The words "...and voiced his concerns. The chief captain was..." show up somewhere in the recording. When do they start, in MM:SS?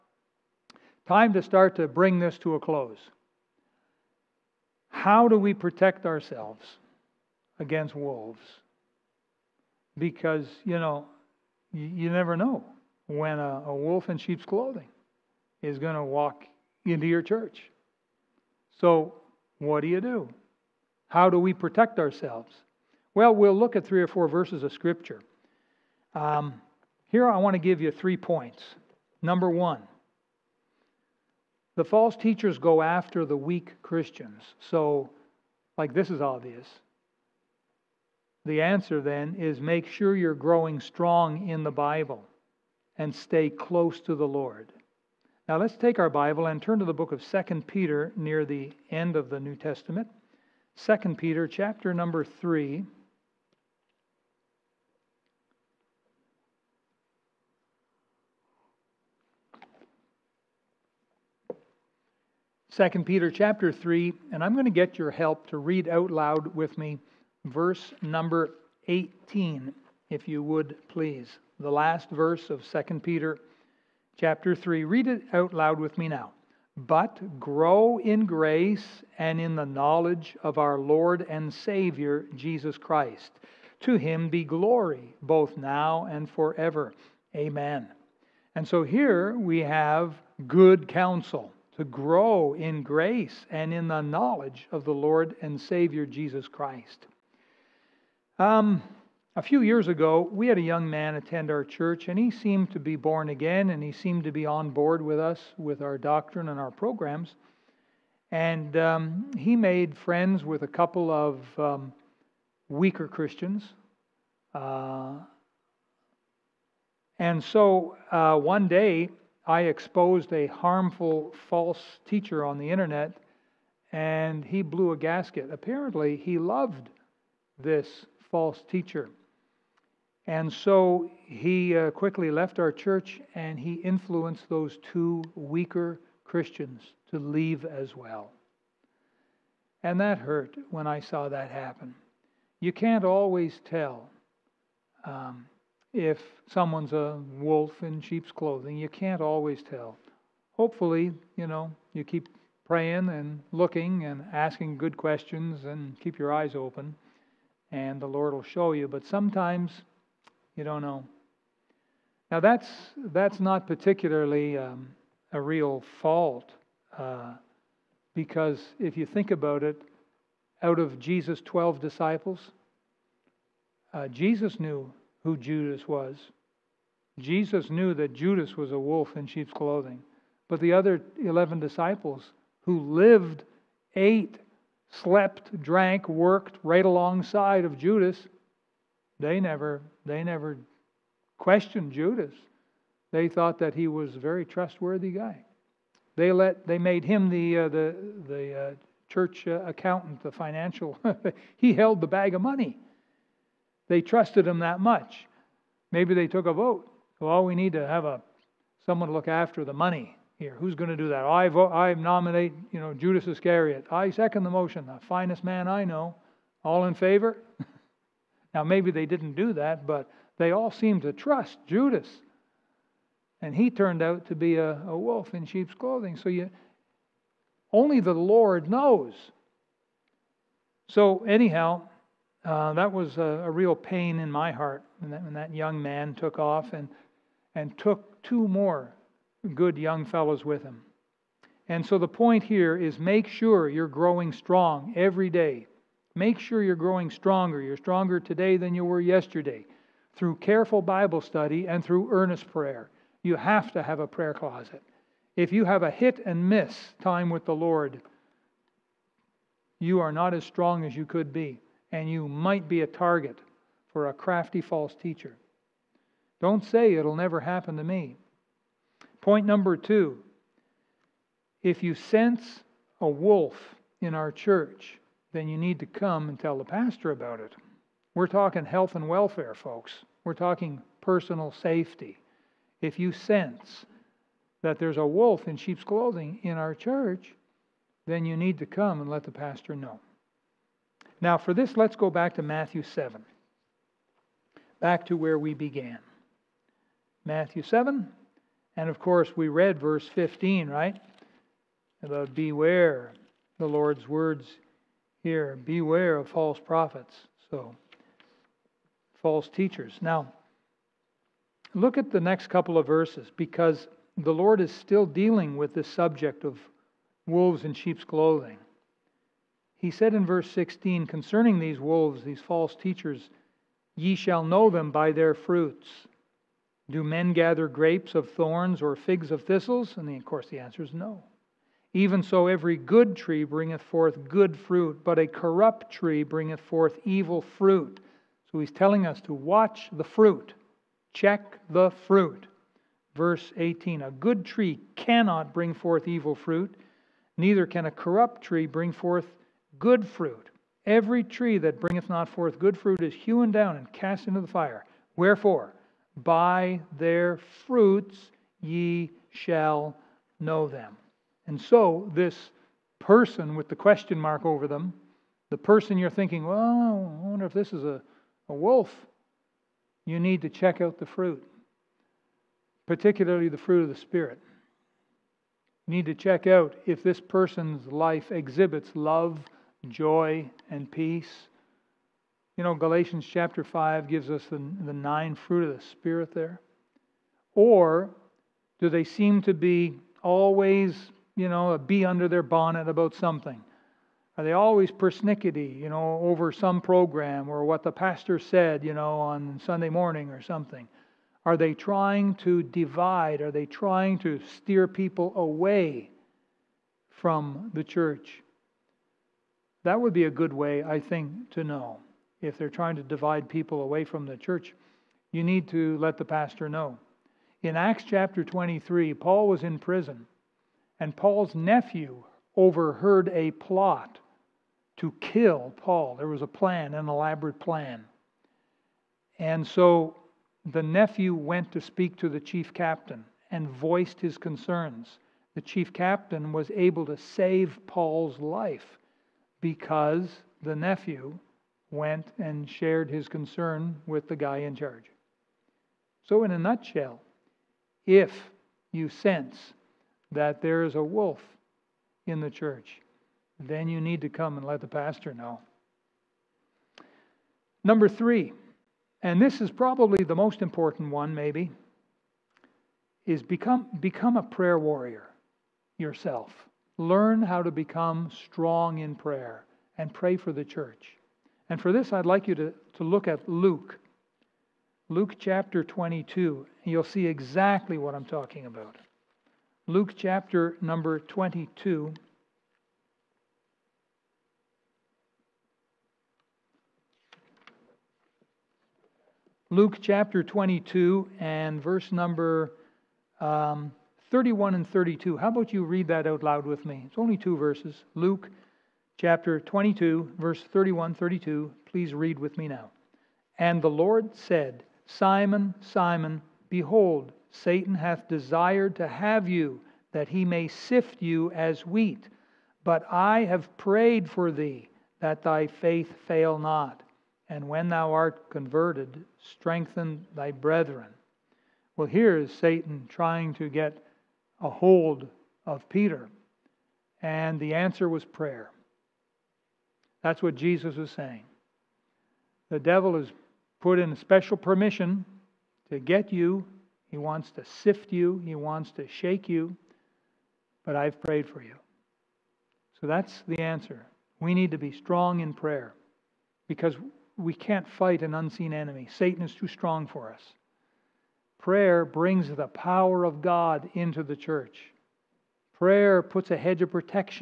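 07:13.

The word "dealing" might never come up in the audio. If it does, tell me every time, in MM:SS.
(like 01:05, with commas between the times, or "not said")
05:15.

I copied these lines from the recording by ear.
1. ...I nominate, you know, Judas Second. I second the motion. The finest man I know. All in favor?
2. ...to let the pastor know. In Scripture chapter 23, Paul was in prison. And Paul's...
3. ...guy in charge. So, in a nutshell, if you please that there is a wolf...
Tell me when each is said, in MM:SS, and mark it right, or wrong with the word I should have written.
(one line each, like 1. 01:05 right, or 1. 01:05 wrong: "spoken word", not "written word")
1. 03:31 wrong: "Iscariot", not "Second"
2. 06:55 wrong: "Acts", not "Scripture"
3. 07:24 wrong: "sense", not "please".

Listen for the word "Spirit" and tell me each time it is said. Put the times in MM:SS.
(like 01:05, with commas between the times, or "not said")
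06:13, 06:25.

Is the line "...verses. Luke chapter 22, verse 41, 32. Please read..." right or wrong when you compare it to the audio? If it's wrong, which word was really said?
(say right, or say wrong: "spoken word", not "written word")
wrong: "31", not "41".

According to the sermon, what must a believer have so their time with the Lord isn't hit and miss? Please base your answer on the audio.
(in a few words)
a prayer closet.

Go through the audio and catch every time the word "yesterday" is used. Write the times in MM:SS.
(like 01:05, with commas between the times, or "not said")
04:09.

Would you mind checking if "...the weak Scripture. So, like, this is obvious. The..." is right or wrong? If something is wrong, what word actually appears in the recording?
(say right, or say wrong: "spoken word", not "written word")
wrong: "Christians", not "Scripture".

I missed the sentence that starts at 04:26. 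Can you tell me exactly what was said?
Don't say it'll never happen to me.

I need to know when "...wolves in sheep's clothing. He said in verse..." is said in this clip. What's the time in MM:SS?
05:17.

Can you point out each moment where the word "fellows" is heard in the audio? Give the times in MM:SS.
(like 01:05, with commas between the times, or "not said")
04:00.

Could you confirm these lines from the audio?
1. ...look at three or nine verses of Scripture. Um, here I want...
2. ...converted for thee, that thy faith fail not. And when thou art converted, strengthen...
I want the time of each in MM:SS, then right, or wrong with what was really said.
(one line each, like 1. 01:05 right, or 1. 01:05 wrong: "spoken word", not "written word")
1. 00:23 wrong: "four", not "nine"
2. 08:33 wrong: "prayed", not "converted".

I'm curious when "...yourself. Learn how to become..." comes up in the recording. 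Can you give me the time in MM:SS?
07:45.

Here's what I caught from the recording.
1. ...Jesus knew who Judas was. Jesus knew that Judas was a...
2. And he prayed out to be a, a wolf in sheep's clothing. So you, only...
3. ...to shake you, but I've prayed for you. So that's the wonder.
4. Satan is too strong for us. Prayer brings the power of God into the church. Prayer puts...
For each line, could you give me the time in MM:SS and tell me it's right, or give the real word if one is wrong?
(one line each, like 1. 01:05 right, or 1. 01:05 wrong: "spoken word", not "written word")
1. 02:54 right
2. 03:43 wrong: "turned", not "prayed"
3. 08:58 wrong: "answer", not "wonder"
4. 09:09 right.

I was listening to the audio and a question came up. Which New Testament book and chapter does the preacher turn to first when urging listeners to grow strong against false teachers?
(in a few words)
2 Peter 3.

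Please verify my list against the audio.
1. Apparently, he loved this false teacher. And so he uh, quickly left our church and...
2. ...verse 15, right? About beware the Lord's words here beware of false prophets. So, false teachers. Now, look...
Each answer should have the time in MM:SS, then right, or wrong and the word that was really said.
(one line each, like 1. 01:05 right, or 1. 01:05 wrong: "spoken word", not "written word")
1. 02:05 right
2. 04:59 right.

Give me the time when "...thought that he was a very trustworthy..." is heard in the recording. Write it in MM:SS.
03:13.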